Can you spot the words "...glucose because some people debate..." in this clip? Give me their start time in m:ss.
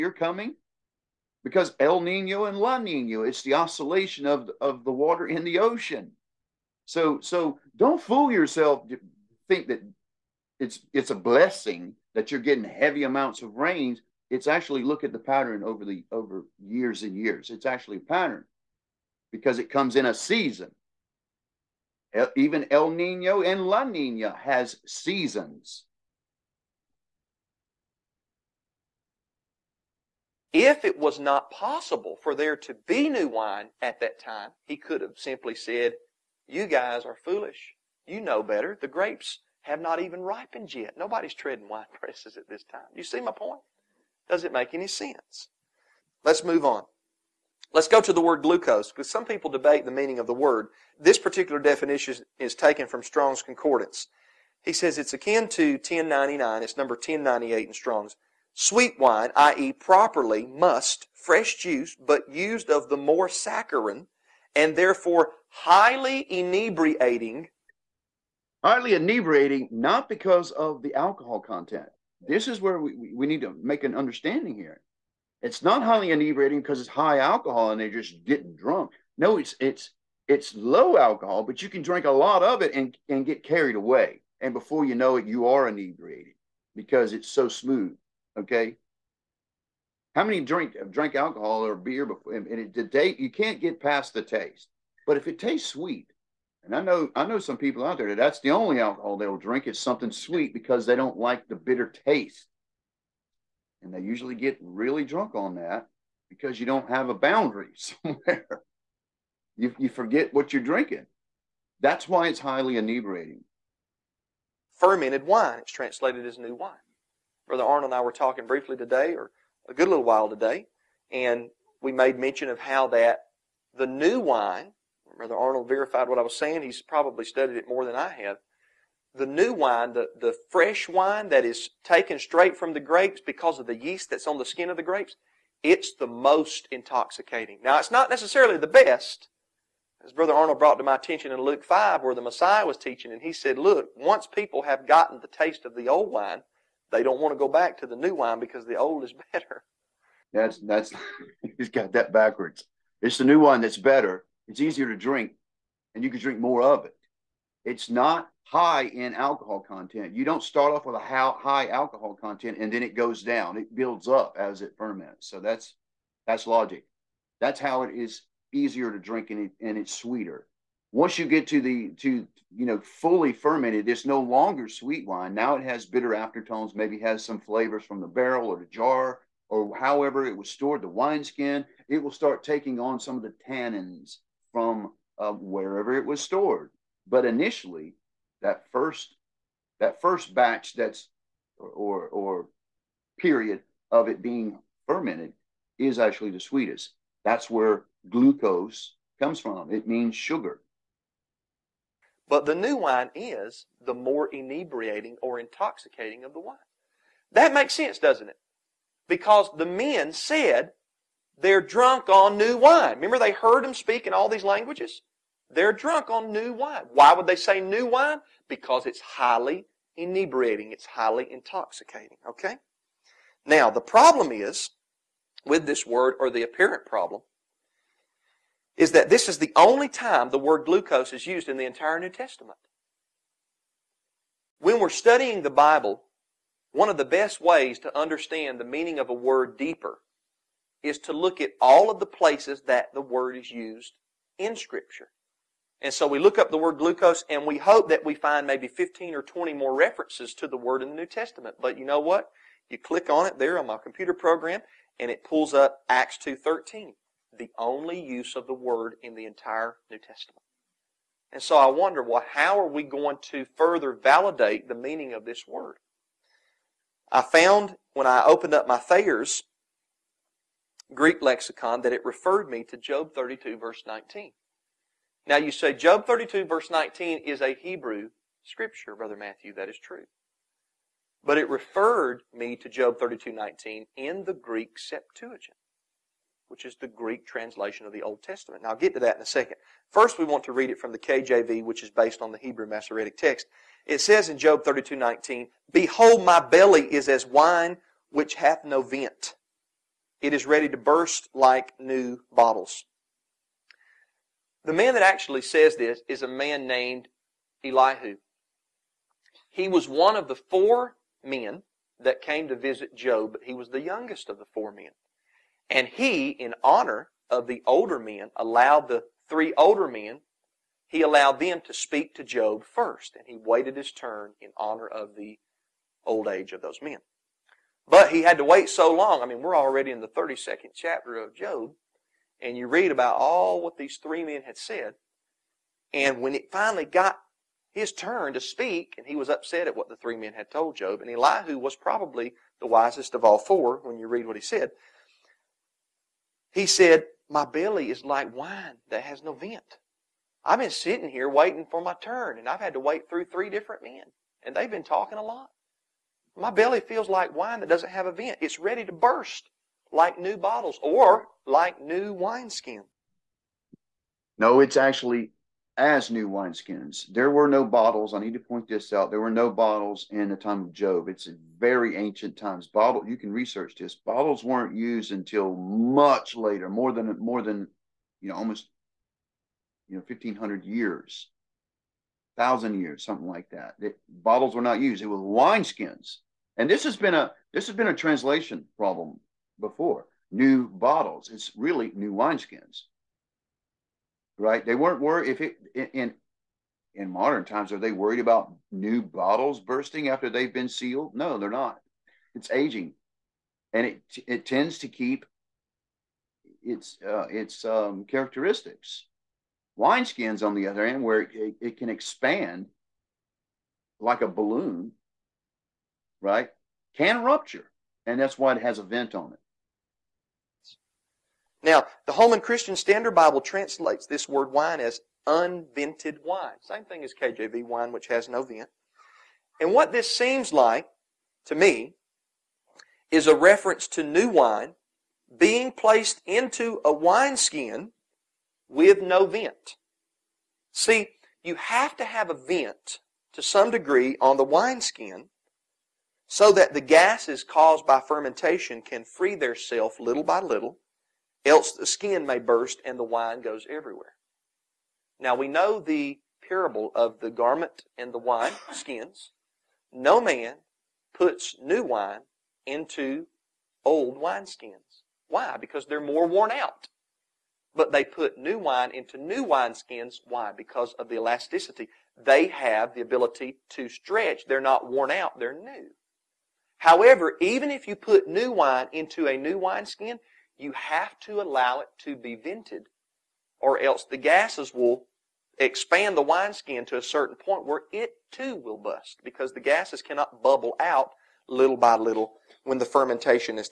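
0:48.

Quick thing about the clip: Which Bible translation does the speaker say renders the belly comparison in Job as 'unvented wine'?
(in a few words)
Holman Christian Standard Bible.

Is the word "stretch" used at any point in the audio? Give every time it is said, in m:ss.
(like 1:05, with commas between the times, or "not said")
7:53.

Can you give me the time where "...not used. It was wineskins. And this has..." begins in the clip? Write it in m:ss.
6:24.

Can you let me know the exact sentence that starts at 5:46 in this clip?
He said, My belly is like wine that has no vent.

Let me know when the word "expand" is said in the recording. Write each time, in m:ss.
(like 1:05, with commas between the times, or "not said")
6:51, 8:05.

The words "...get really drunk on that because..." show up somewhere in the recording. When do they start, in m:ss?
1:44.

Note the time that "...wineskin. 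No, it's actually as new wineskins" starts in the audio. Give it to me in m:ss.
6:02.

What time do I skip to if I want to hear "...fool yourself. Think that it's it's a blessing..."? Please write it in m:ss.
0:08.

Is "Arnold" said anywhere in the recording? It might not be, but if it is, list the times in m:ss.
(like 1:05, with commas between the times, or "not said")
1:57, 2:05, 2:20.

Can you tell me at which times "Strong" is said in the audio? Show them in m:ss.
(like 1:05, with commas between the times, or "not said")
0:53, 0:57.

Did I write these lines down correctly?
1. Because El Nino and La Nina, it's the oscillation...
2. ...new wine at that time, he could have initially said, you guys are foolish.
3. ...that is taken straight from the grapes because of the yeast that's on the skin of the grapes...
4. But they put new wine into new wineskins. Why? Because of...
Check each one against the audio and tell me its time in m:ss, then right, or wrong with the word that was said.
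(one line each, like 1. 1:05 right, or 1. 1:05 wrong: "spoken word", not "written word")
1. 0:01 right
2. 0:33 wrong: "simply", not "initially"
3. 2:11 right
4. 7:47 right.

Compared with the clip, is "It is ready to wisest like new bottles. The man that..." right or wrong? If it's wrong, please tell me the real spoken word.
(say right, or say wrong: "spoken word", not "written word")
wrong: "burst", not "wisest".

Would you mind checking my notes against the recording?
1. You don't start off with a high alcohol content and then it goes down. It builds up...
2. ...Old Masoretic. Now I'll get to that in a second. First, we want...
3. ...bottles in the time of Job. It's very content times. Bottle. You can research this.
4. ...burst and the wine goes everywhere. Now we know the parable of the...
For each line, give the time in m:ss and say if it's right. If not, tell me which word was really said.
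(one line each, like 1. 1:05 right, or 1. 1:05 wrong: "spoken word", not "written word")
1. 2:40 right
2. 4:48 wrong: "Testament", not "Masoretic"
3. 6:09 wrong: "ancient", not "content"
4. 7:32 right.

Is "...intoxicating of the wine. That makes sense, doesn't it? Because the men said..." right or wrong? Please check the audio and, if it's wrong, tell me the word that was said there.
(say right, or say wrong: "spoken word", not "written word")
right.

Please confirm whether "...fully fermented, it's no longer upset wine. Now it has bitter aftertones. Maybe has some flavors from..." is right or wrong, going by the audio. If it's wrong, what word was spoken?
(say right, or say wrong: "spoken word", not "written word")
wrong: "sweet", not "upset".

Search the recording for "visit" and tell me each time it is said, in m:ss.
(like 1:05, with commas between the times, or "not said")
5:12.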